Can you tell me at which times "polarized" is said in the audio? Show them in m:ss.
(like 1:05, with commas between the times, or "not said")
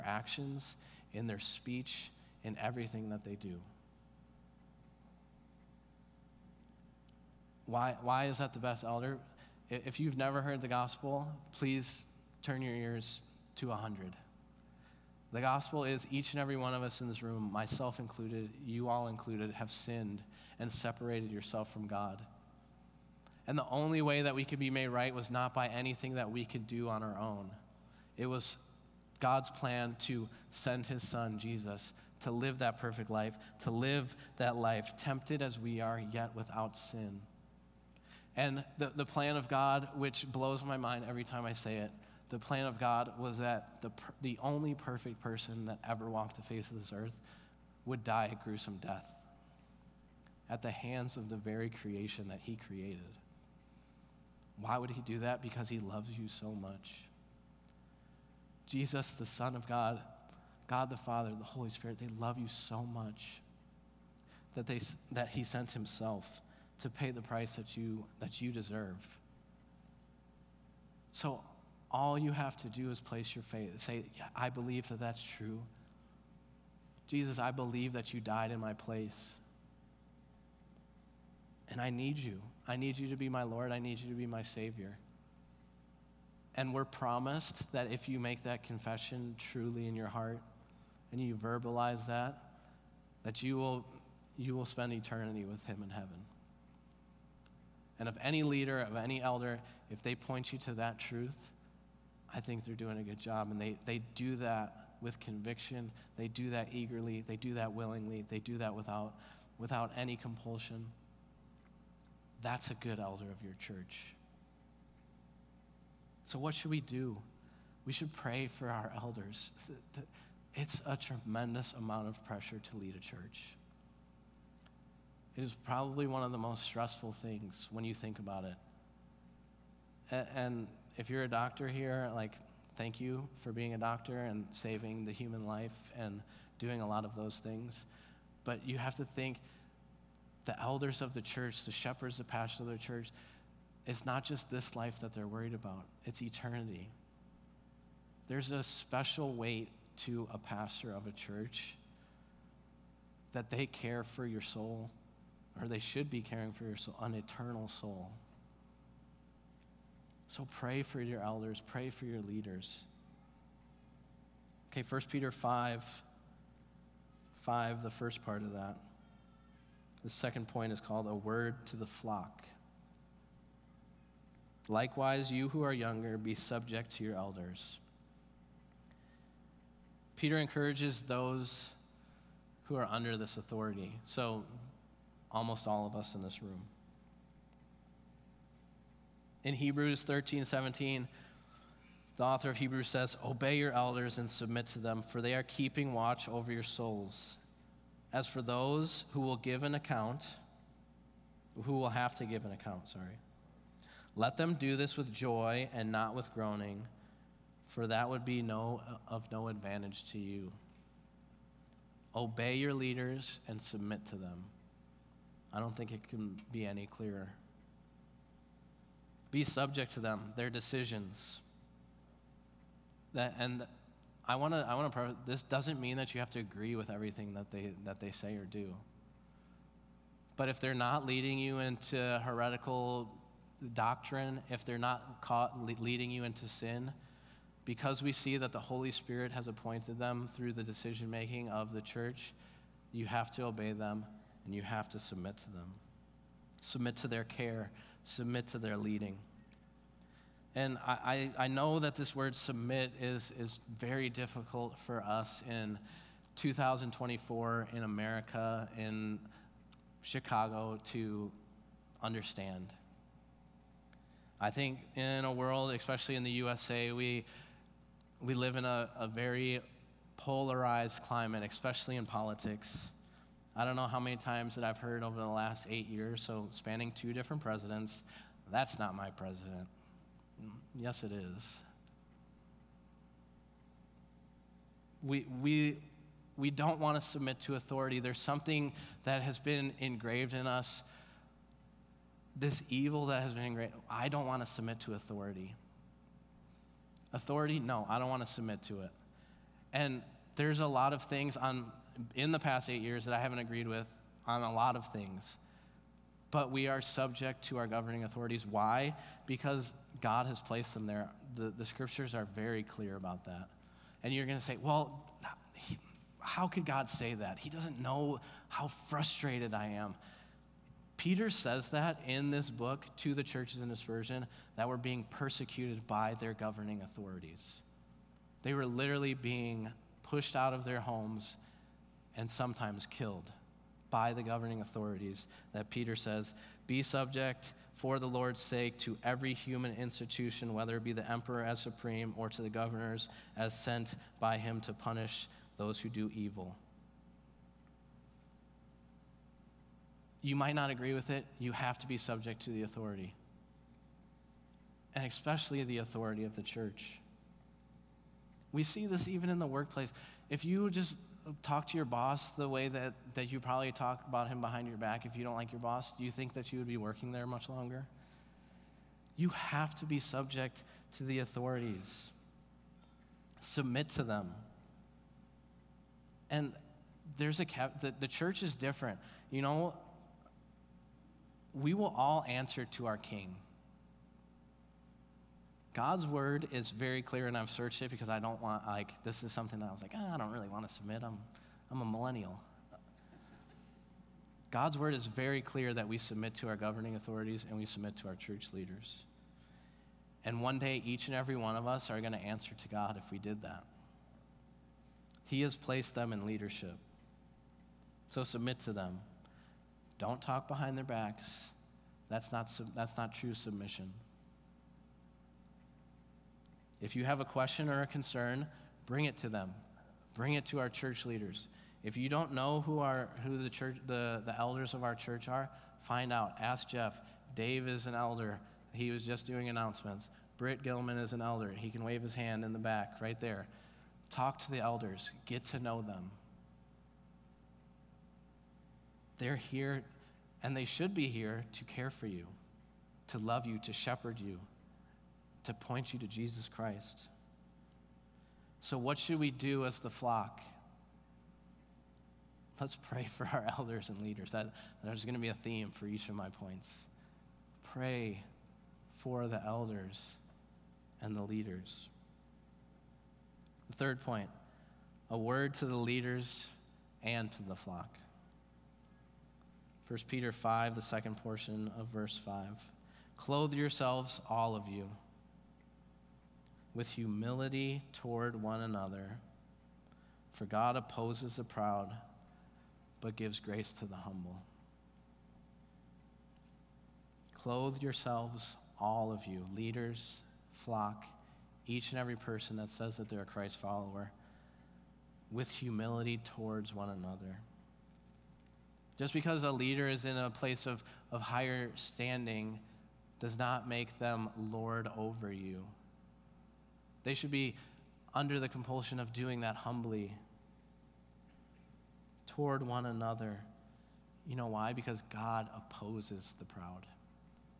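4:30.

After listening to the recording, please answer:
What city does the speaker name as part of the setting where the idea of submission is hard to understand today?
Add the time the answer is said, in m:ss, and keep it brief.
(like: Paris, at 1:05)
Chicago, at 4:20.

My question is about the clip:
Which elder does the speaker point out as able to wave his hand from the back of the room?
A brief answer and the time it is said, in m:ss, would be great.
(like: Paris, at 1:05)
Britt Gilman, at 7:10.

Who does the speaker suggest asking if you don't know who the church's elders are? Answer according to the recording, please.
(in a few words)
Jeff.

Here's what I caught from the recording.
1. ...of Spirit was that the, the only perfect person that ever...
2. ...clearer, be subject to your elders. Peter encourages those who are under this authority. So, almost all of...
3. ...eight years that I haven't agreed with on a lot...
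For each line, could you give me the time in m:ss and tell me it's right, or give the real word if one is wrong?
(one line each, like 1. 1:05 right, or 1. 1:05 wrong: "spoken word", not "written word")
1. 0:42 wrong: "God", not "Spirit"
2. 2:55 wrong: "younger", not "clearer"
3. 5:02 right.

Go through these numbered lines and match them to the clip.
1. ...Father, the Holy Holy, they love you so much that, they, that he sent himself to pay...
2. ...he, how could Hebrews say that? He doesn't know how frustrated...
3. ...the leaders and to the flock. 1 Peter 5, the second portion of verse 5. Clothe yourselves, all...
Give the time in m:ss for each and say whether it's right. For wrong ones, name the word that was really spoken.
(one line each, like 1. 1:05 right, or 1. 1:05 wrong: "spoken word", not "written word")
1. 1:00 wrong: "Spirit", not "Holy"
2. 5:15 wrong: "God", not "Hebrews"
3. 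7:45 right.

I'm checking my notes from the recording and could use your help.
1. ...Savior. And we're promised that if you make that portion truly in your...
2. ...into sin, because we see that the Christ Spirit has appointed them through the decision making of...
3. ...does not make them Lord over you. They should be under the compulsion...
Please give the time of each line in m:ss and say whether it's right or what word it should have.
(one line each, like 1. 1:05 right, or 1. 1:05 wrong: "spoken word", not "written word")
1. 1:24 wrong: "confession", not "portion"
2. 3:56 wrong: "Holy", not "Christ"
3. 8:23 right.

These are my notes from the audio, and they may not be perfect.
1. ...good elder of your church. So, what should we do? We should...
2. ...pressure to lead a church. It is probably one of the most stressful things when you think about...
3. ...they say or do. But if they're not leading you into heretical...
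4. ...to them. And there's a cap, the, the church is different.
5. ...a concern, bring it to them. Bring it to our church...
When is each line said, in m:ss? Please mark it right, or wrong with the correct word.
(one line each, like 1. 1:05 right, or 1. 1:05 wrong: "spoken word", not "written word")
1. 1:52 right
2. 2:02 right
3. 3:48 right
4. 6:13 right
5. 6:57 right.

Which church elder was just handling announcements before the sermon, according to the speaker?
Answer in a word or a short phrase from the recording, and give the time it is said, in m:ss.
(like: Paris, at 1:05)
Dave, at 7:07.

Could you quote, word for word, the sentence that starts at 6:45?
He has placed them in leadership.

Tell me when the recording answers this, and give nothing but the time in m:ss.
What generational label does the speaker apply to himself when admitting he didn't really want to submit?
6:31.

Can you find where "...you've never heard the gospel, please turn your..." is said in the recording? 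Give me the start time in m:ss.
0:09.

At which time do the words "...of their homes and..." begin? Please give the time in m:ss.
5:30.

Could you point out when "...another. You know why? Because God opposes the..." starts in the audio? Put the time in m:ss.
8:32.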